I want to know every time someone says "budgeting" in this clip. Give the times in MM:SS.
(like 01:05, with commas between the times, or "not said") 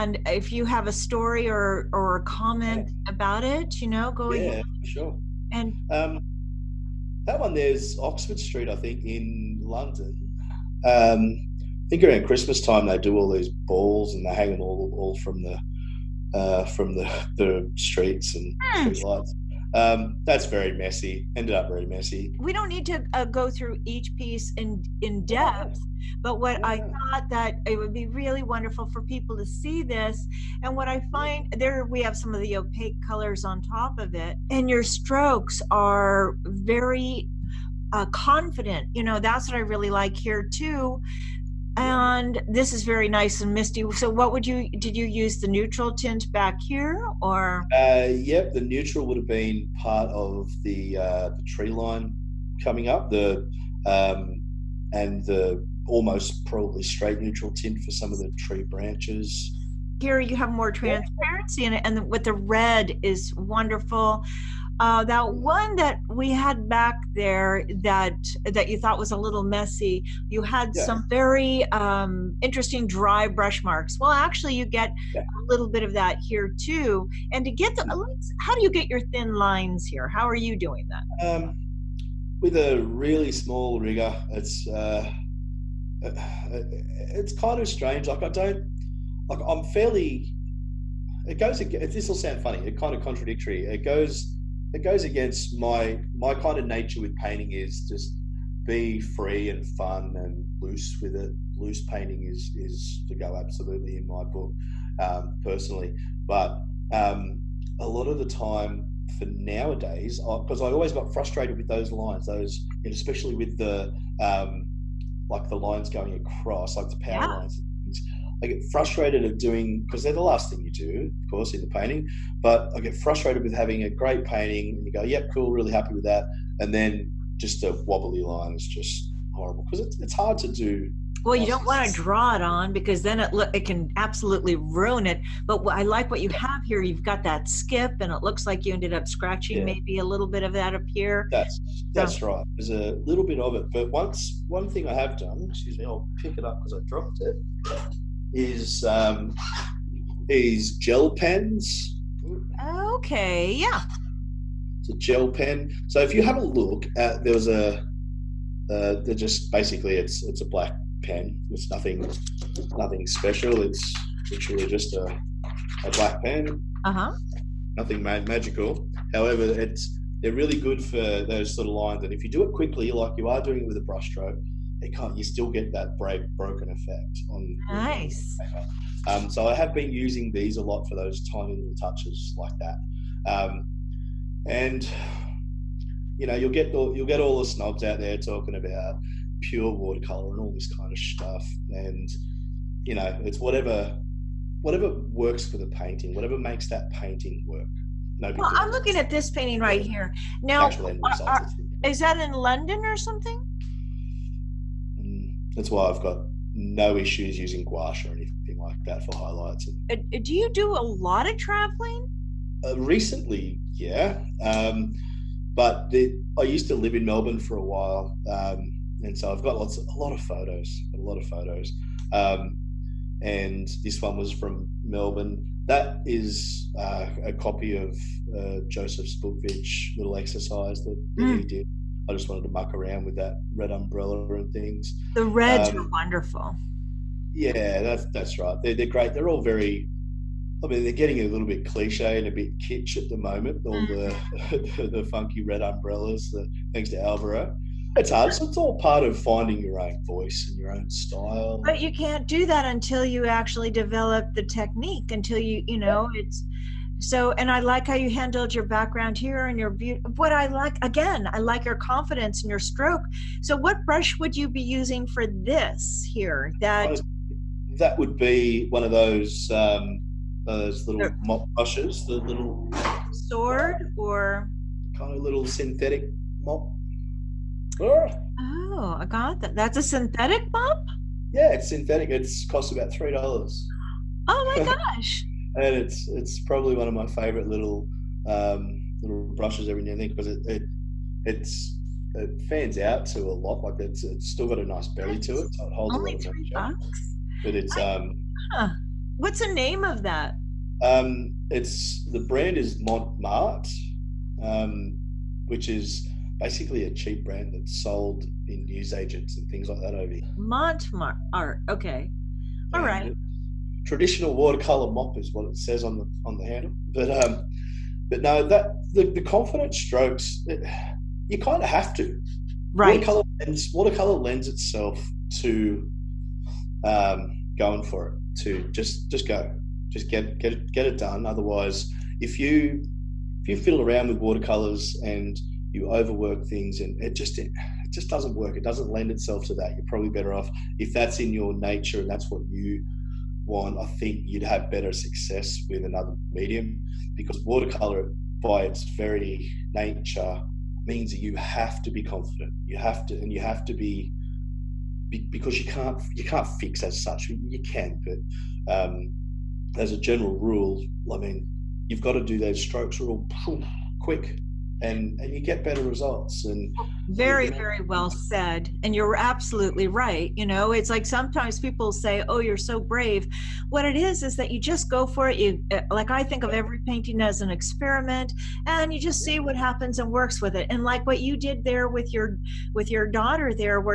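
not said.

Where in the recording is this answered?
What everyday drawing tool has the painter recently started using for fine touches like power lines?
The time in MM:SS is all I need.
02:30.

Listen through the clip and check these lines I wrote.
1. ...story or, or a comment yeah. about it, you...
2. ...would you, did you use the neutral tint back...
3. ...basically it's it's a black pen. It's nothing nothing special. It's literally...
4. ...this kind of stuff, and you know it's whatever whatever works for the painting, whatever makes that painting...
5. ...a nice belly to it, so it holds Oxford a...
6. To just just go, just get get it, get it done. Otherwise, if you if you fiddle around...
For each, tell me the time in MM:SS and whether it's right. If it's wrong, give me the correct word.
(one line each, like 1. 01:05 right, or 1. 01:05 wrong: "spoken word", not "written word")
1. 00:00 right
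2. 00:44 right
3. 02:39 right
4. 03:10 right
5. 04:54 wrong: "Only", not "Oxford"
6. 05:28 right.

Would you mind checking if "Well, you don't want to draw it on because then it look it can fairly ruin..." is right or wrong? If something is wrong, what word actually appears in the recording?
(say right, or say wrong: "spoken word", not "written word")
wrong: "absolutely", not "fairly".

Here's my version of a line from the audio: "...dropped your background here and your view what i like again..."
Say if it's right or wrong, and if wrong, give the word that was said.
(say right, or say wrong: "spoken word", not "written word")
wrong: "handled", not "dropped".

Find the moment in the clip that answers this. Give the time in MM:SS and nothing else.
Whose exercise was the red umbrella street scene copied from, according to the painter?
03:48.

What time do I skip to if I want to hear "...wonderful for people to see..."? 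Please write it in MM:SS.
00:28.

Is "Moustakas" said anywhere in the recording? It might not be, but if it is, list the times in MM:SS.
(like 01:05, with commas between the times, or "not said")
not said.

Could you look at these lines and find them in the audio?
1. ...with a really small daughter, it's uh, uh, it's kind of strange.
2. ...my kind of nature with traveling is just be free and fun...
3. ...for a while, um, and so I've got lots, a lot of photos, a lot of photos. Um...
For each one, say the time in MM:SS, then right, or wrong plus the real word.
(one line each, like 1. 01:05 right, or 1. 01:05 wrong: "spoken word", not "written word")
1. 01:22 wrong: "rigger", not "daughter"
2. 01:36 wrong: "painting", not "traveling"
3. 03:37 right.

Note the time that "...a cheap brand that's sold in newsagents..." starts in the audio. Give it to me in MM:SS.
05:06.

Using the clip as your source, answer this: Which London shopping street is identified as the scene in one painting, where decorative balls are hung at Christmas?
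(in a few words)
Oxford Street.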